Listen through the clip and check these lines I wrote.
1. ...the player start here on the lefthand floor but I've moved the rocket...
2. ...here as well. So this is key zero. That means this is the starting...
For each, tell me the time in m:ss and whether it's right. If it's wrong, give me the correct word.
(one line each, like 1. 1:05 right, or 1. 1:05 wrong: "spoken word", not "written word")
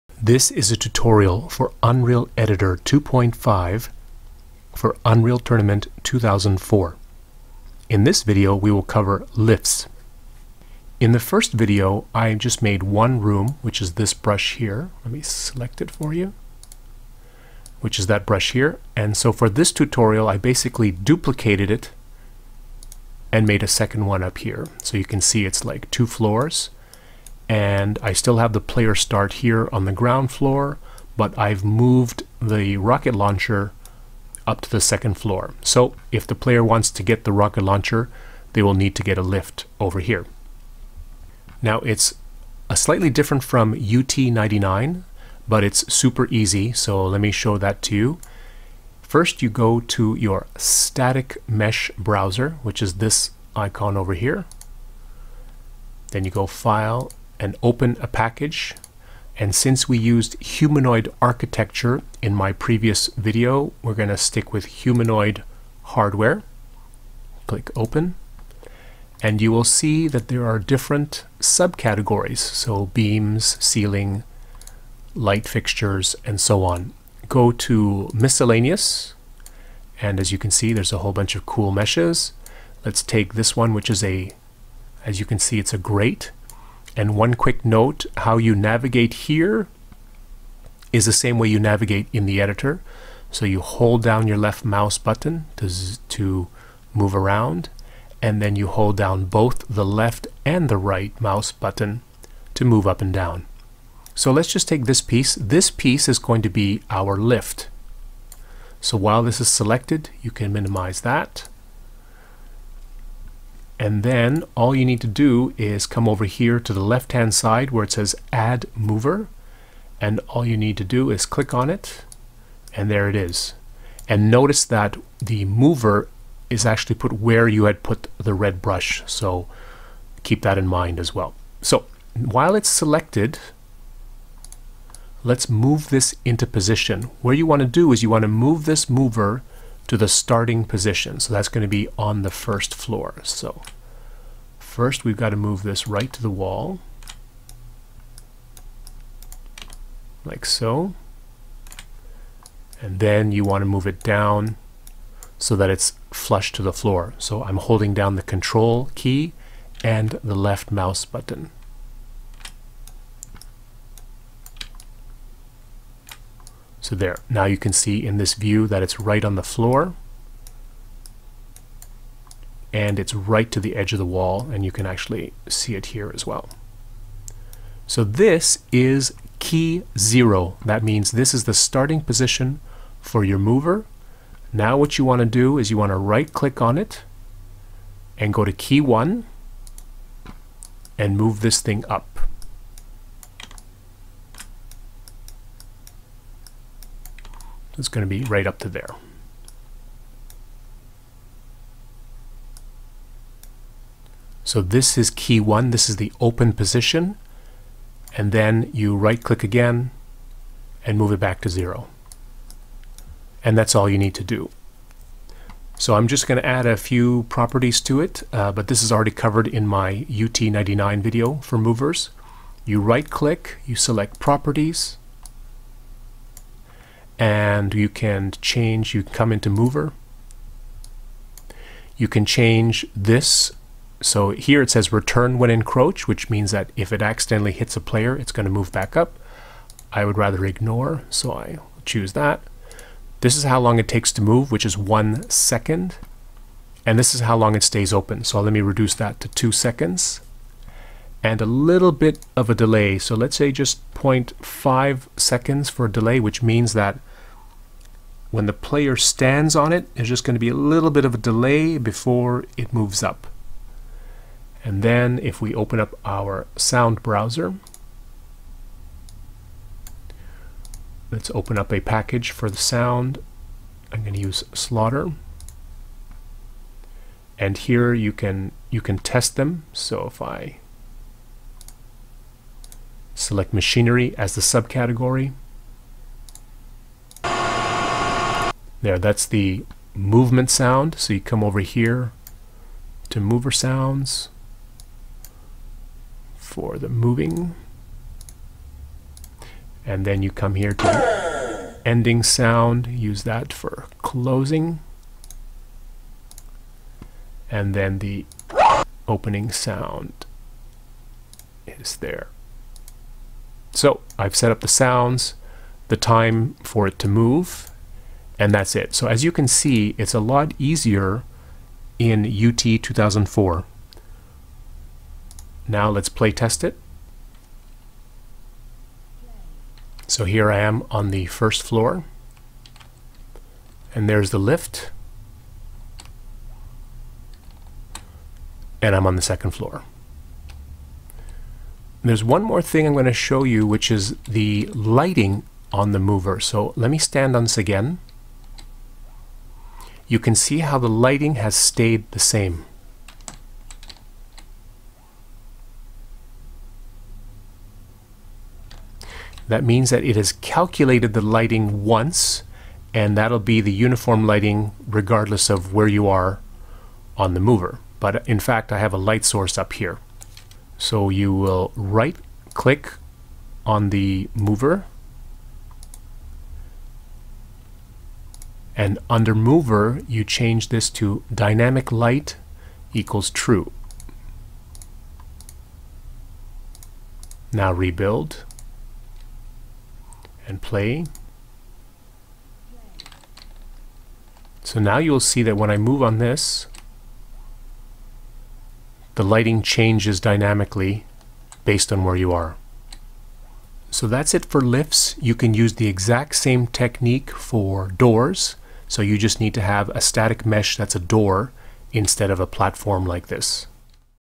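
1. 0:28 wrong: "ground", not "lefthand"
2. 2:55 right.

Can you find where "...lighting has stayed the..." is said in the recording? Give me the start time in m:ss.
5:50.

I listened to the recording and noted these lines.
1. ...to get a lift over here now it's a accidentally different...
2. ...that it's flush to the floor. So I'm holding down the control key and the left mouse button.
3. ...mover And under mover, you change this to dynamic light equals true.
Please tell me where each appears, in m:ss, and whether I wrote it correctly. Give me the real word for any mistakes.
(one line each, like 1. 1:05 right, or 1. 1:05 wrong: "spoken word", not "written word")
1. 0:38 wrong: "slightly", not "accidentally"
2. 2:35 right
3. 6:14 right.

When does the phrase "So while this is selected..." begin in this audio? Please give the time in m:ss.
1:48.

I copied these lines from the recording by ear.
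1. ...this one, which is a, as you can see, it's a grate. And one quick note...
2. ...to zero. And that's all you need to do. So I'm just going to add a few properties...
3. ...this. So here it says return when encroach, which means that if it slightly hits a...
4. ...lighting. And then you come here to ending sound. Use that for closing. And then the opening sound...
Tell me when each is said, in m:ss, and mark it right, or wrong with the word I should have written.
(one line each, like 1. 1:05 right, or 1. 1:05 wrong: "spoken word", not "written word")
1. 1:23 right
2. 3:31 right
3. 3:52 wrong: "accidentally", not "slightly"
4. 4:56 wrong: "moving", not "lighting".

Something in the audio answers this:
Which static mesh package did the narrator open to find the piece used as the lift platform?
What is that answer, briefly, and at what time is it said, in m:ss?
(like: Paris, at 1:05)
humanoid hardware, at 1:04.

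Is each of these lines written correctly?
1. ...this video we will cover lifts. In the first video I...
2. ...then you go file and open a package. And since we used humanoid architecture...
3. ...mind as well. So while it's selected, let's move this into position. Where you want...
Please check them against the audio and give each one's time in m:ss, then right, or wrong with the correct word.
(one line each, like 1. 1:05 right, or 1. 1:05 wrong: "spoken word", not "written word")
1. 0:08 right
2. 0:56 right
3. 2:10 right.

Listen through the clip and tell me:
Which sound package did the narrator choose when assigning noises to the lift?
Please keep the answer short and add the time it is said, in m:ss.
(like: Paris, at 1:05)
Slaughter, at 4:34.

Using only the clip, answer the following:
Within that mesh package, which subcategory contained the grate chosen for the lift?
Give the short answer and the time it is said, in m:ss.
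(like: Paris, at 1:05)
miscellaneous, at 1:18.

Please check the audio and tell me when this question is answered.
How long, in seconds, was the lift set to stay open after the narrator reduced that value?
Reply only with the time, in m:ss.
4:09.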